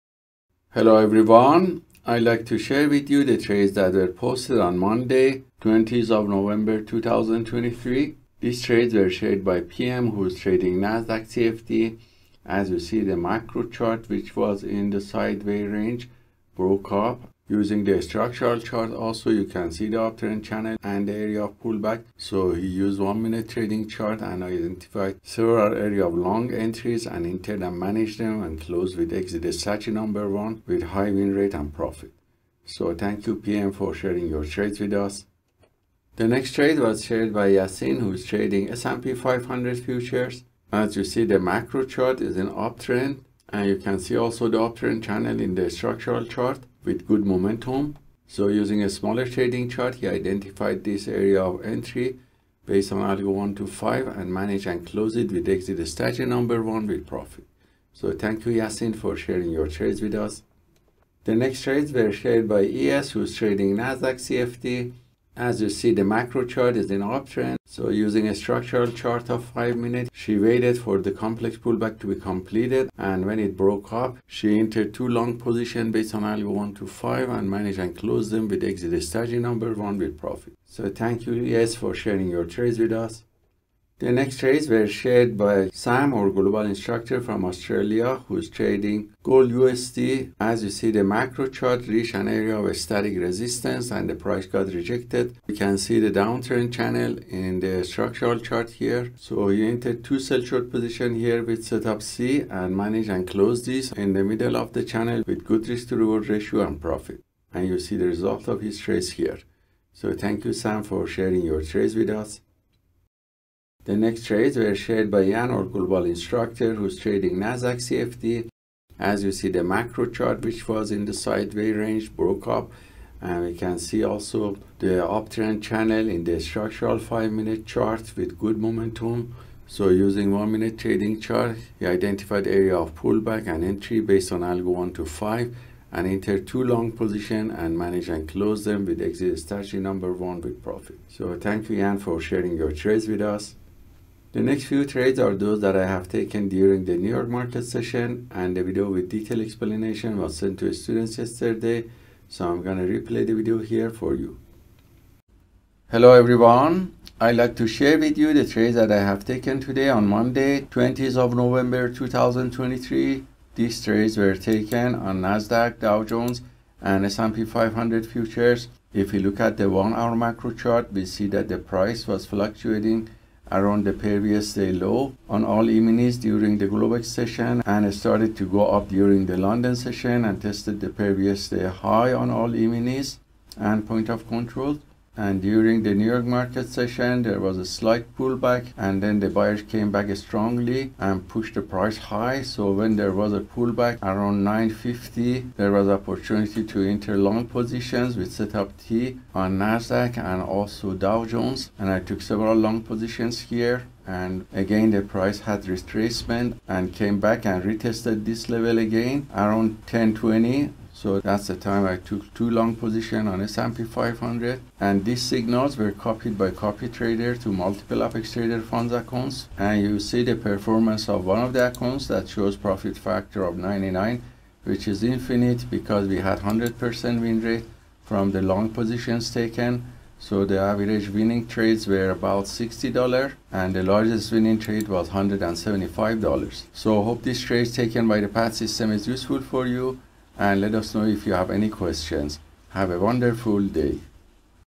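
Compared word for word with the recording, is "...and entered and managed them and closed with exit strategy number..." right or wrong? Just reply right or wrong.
right.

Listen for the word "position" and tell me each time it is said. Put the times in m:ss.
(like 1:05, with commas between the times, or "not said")
1:15, 1:40, 2:16, 3:17, 3:22, 3:32, 3:48.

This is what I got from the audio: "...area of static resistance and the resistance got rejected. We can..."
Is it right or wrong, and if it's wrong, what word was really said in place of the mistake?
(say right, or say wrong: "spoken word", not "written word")
wrong: "price", not "resistance".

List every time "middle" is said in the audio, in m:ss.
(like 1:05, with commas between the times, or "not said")
1:44.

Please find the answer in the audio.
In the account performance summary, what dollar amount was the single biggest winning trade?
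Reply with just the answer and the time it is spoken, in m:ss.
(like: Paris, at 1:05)
$175, at 3:55.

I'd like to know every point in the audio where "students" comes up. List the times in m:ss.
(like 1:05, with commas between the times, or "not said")
2:30.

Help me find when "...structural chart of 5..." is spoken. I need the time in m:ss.
1:08.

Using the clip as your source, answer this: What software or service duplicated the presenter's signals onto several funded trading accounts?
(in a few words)
copy trader.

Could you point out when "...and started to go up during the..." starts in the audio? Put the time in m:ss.
2:57.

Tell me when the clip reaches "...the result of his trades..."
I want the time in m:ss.
1:47.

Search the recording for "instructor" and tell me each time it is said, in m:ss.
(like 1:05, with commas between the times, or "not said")
1:26, 1:56.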